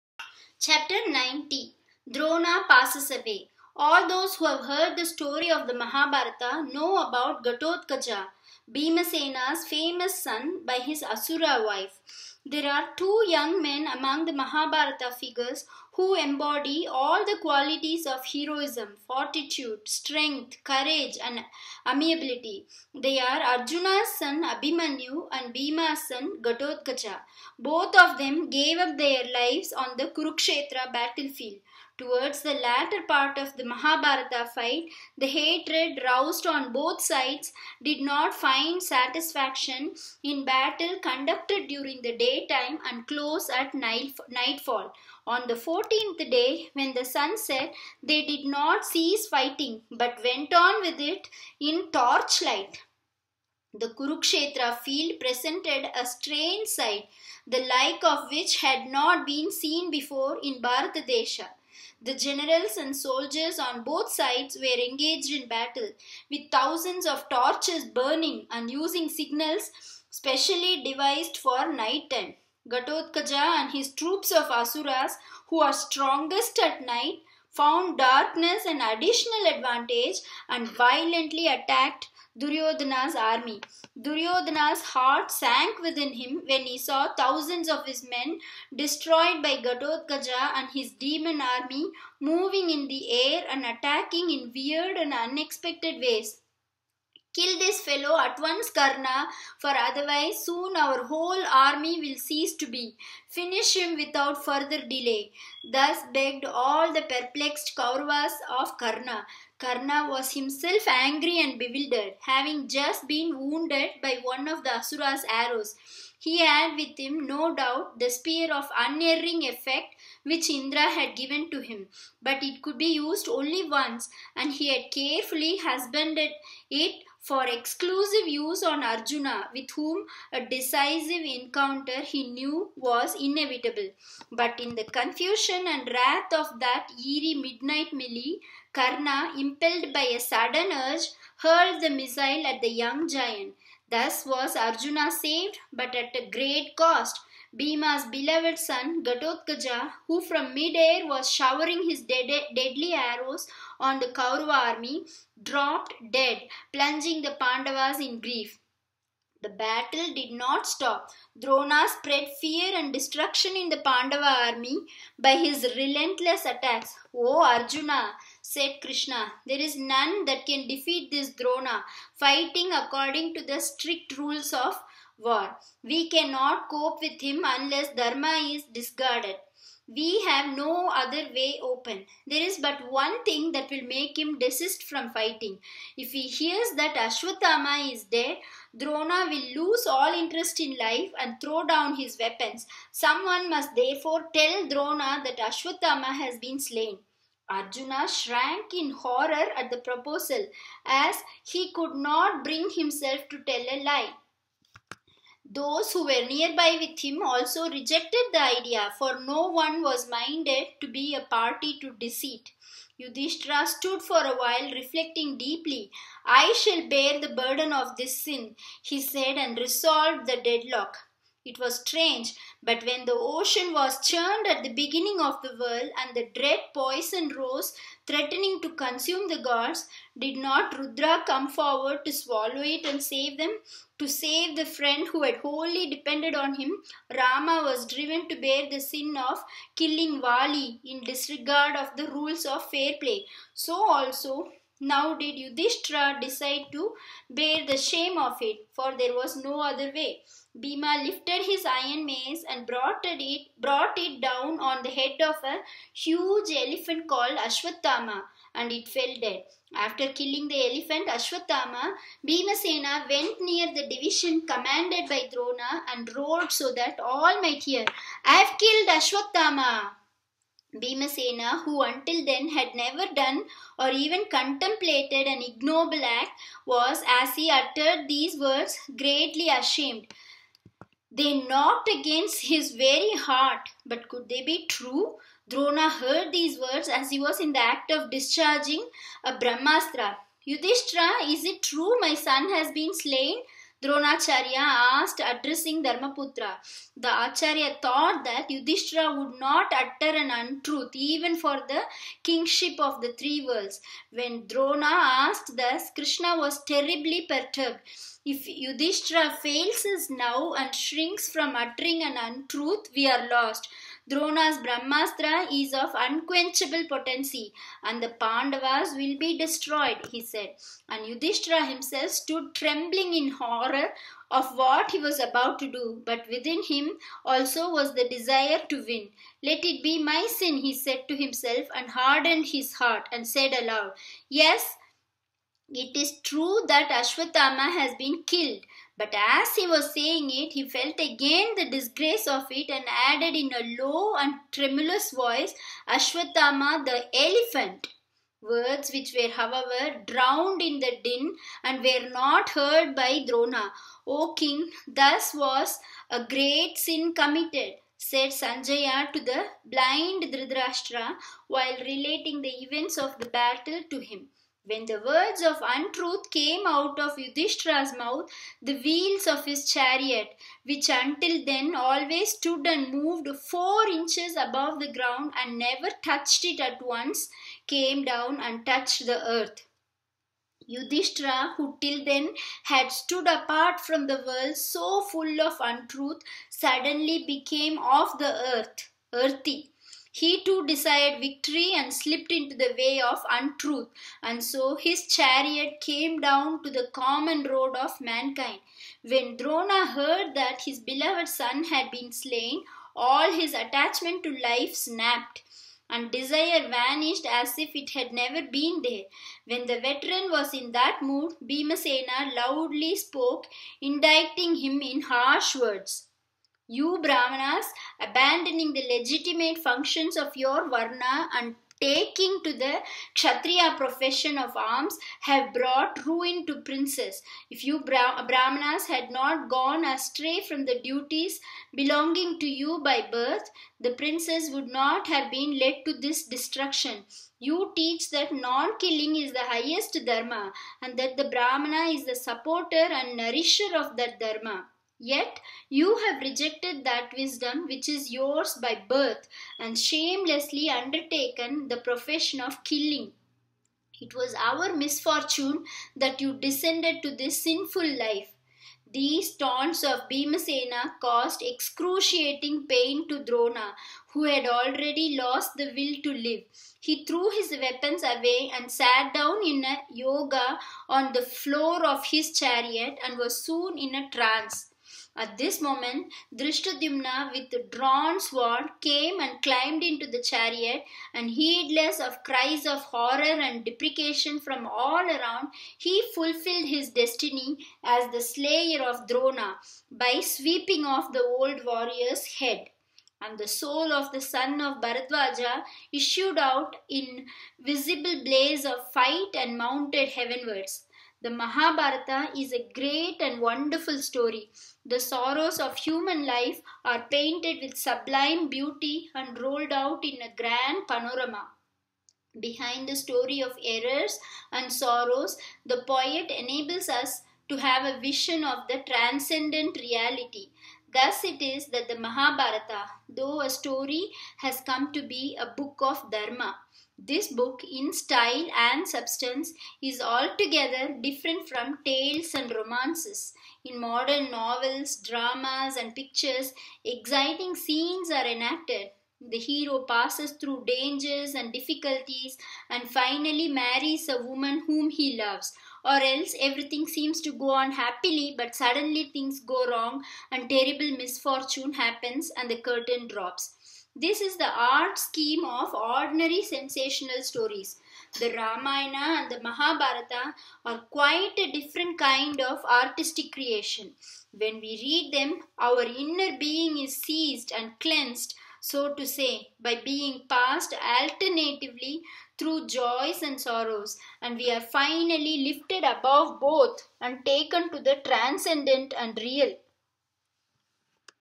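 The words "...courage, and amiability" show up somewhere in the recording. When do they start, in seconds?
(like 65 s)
20 s.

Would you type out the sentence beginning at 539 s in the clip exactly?
The hero passes through dangers and difficulties and finally marries a woman whom he loves.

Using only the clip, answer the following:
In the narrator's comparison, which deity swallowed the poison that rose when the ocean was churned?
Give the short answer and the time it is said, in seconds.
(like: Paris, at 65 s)
Rudra, at 230 s.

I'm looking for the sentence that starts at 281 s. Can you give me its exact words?
They knocked against his very heart, but could they be true?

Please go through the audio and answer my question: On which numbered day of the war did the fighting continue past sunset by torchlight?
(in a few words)
14th.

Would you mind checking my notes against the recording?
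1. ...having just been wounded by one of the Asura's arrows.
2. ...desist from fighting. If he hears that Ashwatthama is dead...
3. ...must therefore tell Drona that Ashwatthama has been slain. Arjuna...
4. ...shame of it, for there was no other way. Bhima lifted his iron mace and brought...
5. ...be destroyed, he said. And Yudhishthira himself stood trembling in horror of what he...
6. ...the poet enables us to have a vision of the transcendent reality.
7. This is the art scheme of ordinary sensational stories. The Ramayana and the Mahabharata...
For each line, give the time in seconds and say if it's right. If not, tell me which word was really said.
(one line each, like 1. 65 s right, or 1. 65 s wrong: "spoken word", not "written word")
1. 112 s right
2. 184 s right
3. 193 s right
4. 247 s right
5. 319 s right
6. 515 s right
7. 553 s right.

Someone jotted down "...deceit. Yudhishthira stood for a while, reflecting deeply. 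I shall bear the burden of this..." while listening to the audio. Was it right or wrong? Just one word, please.
right.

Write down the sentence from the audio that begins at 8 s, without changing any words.
Bhimasena's famous son by his Asura wife.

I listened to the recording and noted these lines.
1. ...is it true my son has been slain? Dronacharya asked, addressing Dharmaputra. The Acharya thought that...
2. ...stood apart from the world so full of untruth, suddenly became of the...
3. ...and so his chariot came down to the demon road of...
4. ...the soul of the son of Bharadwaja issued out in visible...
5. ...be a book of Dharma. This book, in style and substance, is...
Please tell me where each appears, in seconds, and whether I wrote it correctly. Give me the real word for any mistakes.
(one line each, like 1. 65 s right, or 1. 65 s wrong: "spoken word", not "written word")
1. 291 s right
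2. 382 s right
3. 394 s wrong: "common", not "demon"
4. 493 s right
5. 525 s right.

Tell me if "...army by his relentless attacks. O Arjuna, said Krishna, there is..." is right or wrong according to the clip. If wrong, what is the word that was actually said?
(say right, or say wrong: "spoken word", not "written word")
right.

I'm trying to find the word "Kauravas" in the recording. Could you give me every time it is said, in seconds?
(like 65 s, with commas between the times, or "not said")
107 s, 154 s.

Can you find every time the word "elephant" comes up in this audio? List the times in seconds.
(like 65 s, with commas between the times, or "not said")
256 s, 260 s, 347 s.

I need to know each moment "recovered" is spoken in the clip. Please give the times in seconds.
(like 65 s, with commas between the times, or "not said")
not said.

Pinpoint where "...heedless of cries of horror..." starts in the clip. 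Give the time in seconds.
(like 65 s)
481 s.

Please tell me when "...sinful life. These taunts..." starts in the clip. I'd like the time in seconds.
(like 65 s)
457 s.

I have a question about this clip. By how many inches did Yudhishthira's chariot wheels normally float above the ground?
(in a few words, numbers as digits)
4.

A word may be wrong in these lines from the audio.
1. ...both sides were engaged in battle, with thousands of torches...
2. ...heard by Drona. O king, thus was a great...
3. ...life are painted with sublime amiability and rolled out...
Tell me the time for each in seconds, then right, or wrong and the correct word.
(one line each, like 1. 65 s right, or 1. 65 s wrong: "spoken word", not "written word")
1. 63 s right
2. 352 s right
3. 506 s wrong: "beauty", not "amiability".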